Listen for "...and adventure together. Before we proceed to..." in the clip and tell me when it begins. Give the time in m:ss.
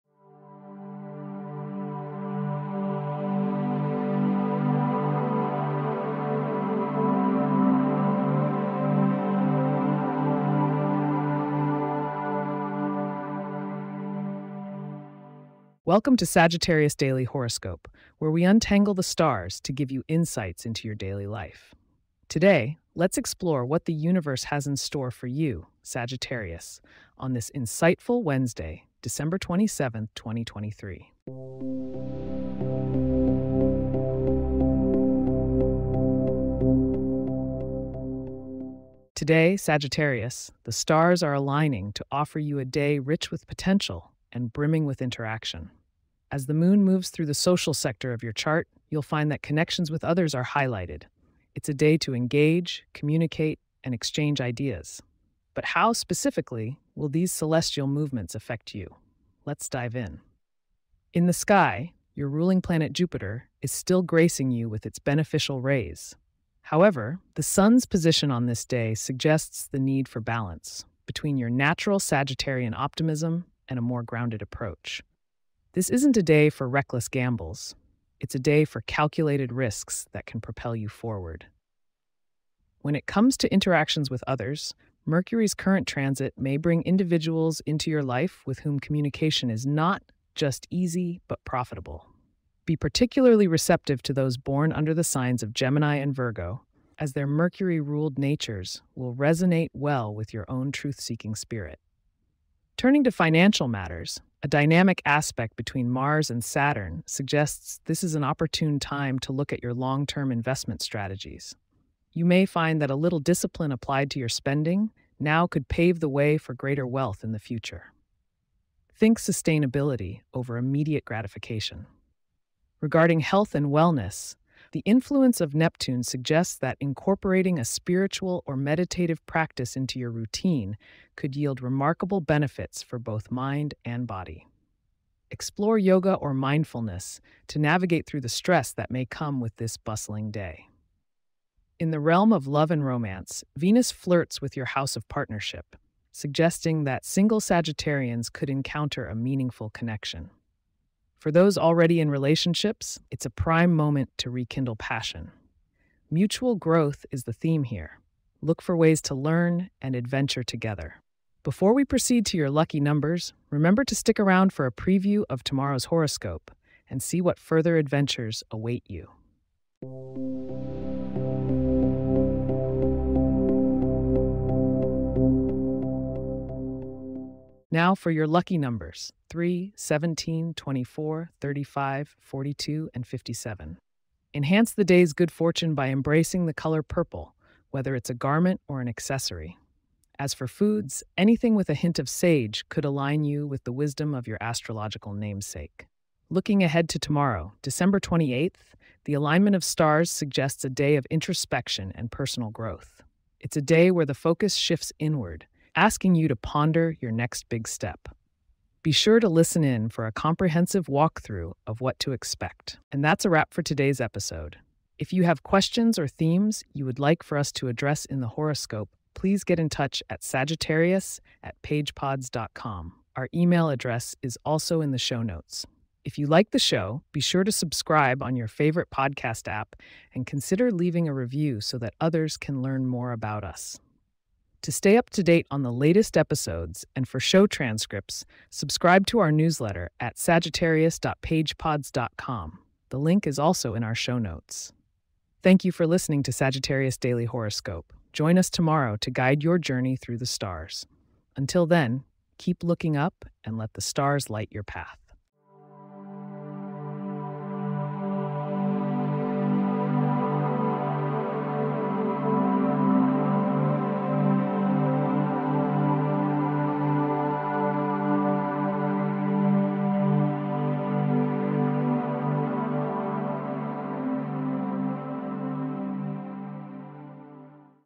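2:39.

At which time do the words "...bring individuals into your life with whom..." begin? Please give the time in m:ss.
1:26.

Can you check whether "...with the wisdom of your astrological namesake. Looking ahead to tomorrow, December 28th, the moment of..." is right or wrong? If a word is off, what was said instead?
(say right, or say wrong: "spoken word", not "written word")
wrong: "alignment", not "moment".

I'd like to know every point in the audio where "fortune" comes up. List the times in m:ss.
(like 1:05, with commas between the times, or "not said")
3:05.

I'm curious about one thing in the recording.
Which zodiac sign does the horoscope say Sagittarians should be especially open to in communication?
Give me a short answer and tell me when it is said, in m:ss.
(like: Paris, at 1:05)
Gemini, at 1:35.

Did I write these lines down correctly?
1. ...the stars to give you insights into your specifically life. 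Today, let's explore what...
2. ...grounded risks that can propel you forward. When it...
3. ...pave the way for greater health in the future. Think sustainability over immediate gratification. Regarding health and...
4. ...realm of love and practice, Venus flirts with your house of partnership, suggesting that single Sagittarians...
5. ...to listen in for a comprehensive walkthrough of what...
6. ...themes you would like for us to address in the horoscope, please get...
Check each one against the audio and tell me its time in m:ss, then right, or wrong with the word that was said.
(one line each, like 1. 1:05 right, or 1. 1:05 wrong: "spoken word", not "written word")
1. 0:18 wrong: "daily", not "specifically"
2. 1:18 wrong: "calculated", not "grounded"
3. 1:55 wrong: "wealth", not "health"
4. 2:21 wrong: "romance", not "practice"
5. 3:29 right
6. 3:36 right.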